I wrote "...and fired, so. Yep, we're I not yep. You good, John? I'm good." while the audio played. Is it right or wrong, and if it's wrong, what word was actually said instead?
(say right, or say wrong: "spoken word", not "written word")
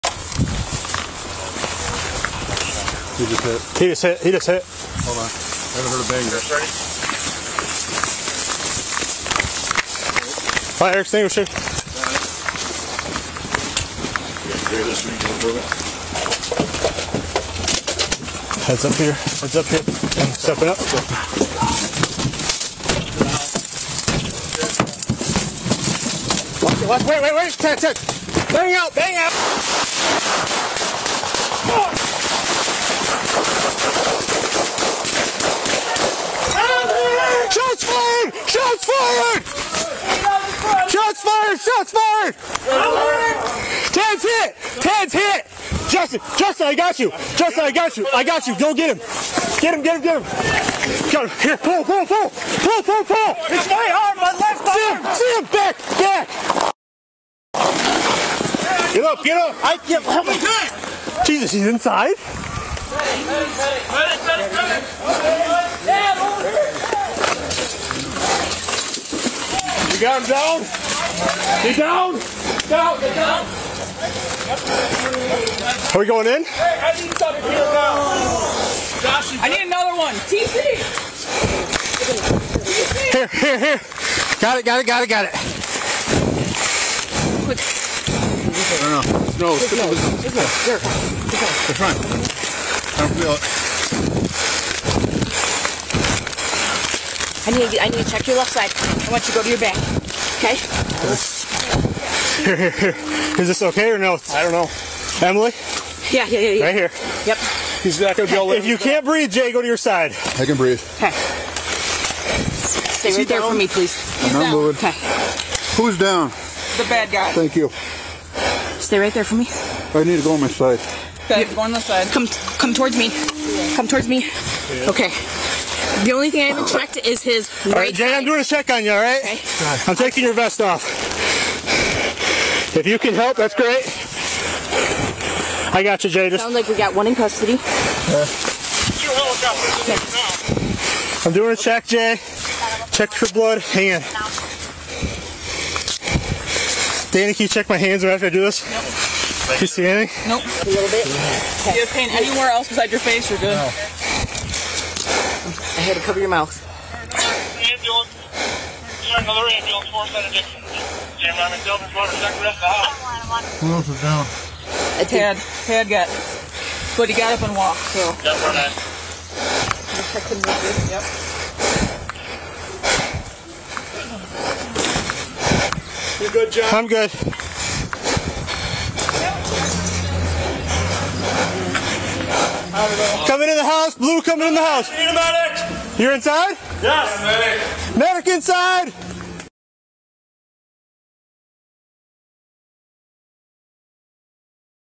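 wrong: "walked", not "fired".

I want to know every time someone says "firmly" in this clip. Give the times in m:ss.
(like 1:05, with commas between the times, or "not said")
not said.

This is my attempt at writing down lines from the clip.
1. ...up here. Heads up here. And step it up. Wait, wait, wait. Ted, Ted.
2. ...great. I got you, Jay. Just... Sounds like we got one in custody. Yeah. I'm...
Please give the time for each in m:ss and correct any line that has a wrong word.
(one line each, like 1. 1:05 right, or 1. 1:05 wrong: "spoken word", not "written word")
1. 0:18 right
2. 2:13 right.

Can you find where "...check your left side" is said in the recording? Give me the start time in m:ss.
1:38.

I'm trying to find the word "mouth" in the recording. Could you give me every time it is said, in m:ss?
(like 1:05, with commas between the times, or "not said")
2:36.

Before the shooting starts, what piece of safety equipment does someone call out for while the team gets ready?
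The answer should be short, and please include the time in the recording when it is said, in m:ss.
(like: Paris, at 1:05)
Fire extinguisher, at 0:10.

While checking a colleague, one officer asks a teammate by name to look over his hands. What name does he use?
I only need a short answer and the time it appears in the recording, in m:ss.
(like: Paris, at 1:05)
Danny, at 2:27.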